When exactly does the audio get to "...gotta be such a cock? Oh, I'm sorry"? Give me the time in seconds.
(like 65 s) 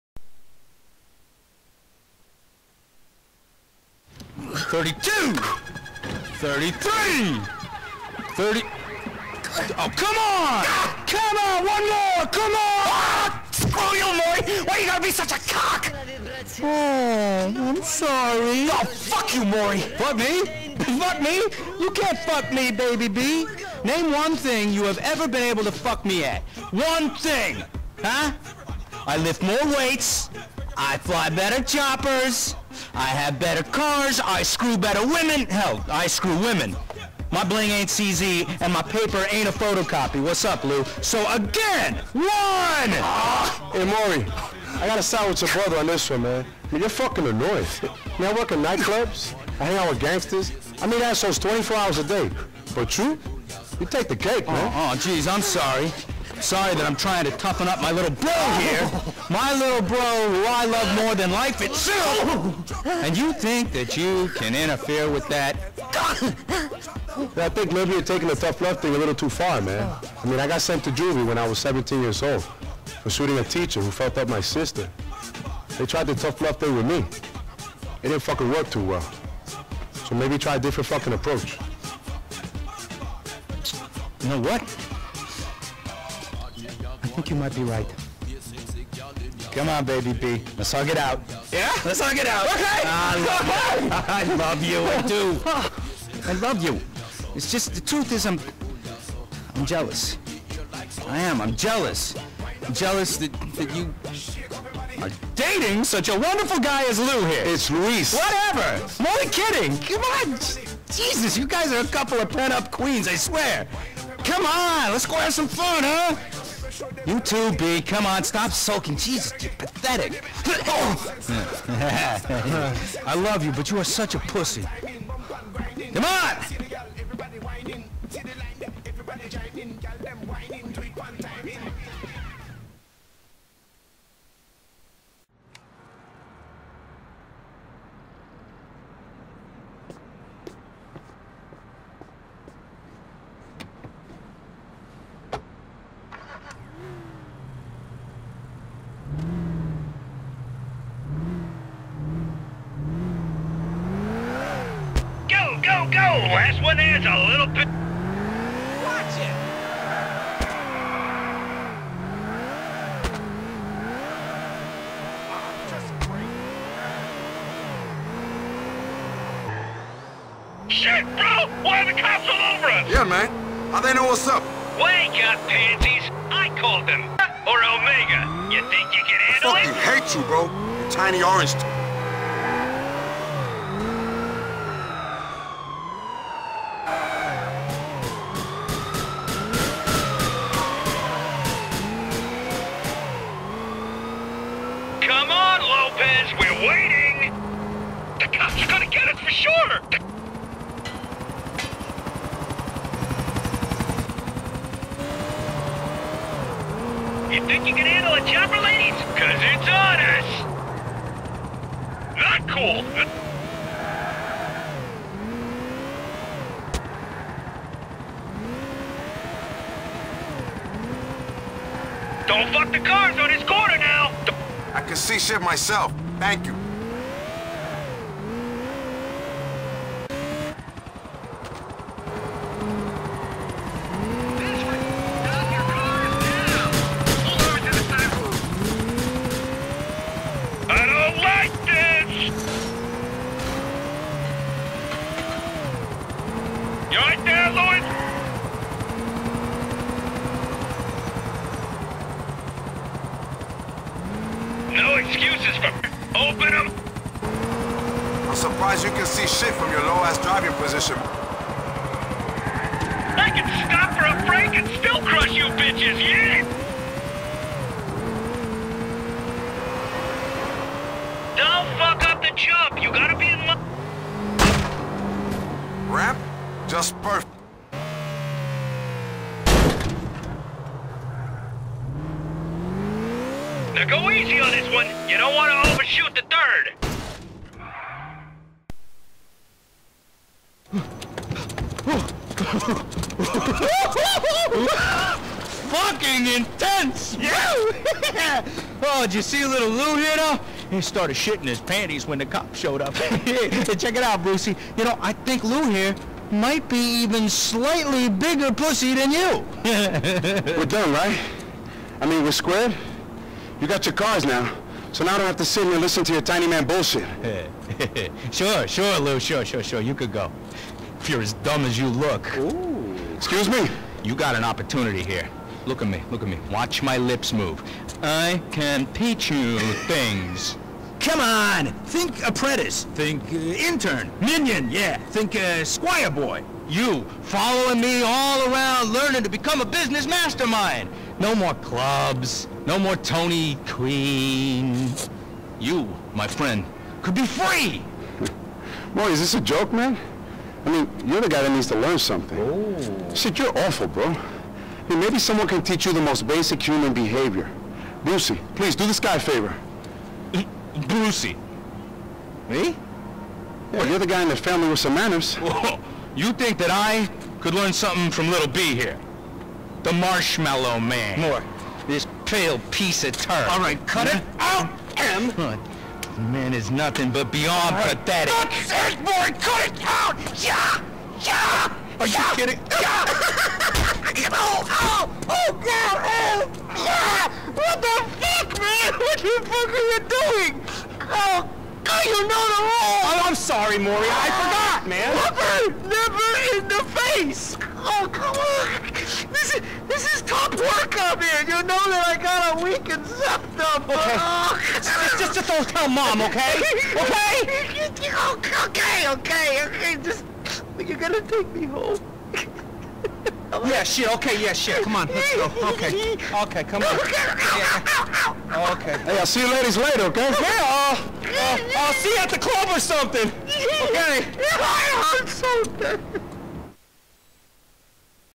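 14 s.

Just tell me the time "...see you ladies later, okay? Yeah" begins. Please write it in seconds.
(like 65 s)
419 s.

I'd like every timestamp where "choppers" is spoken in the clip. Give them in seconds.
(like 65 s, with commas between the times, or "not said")
31 s, 208 s.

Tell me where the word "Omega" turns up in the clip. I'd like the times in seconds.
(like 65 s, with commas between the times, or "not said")
177 s.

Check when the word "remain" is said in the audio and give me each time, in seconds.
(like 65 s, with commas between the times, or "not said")
not said.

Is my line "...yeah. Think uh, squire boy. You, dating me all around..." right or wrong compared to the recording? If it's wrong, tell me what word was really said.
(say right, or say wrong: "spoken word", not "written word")
wrong: "following", not "dating".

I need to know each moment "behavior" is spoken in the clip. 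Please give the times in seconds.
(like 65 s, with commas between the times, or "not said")
356 s.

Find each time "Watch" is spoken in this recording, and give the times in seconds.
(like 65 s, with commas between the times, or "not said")
158 s, 326 s.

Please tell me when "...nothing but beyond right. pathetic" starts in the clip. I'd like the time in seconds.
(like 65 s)
376 s.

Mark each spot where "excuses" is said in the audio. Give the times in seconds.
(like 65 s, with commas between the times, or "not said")
254 s, 323 s.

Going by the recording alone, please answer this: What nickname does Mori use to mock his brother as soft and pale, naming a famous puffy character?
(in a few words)
The Marshmallow Man.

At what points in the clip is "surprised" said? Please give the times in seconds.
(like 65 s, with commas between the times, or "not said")
258 s.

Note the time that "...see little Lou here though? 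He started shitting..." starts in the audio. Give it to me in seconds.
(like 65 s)
299 s.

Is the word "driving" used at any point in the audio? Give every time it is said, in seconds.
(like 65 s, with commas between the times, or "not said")
260 s.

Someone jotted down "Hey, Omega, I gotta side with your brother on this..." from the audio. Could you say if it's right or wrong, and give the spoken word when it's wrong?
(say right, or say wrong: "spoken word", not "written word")
wrong: "Mori", not "Omega".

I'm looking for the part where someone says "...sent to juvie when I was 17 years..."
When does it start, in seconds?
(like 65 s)
70 s.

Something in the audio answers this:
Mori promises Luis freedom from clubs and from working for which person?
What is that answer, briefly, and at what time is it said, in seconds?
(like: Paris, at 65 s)
Tony, at 342 s.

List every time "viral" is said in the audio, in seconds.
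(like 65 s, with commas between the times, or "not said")
not said.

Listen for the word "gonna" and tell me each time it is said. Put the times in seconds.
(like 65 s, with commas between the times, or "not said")
410 s.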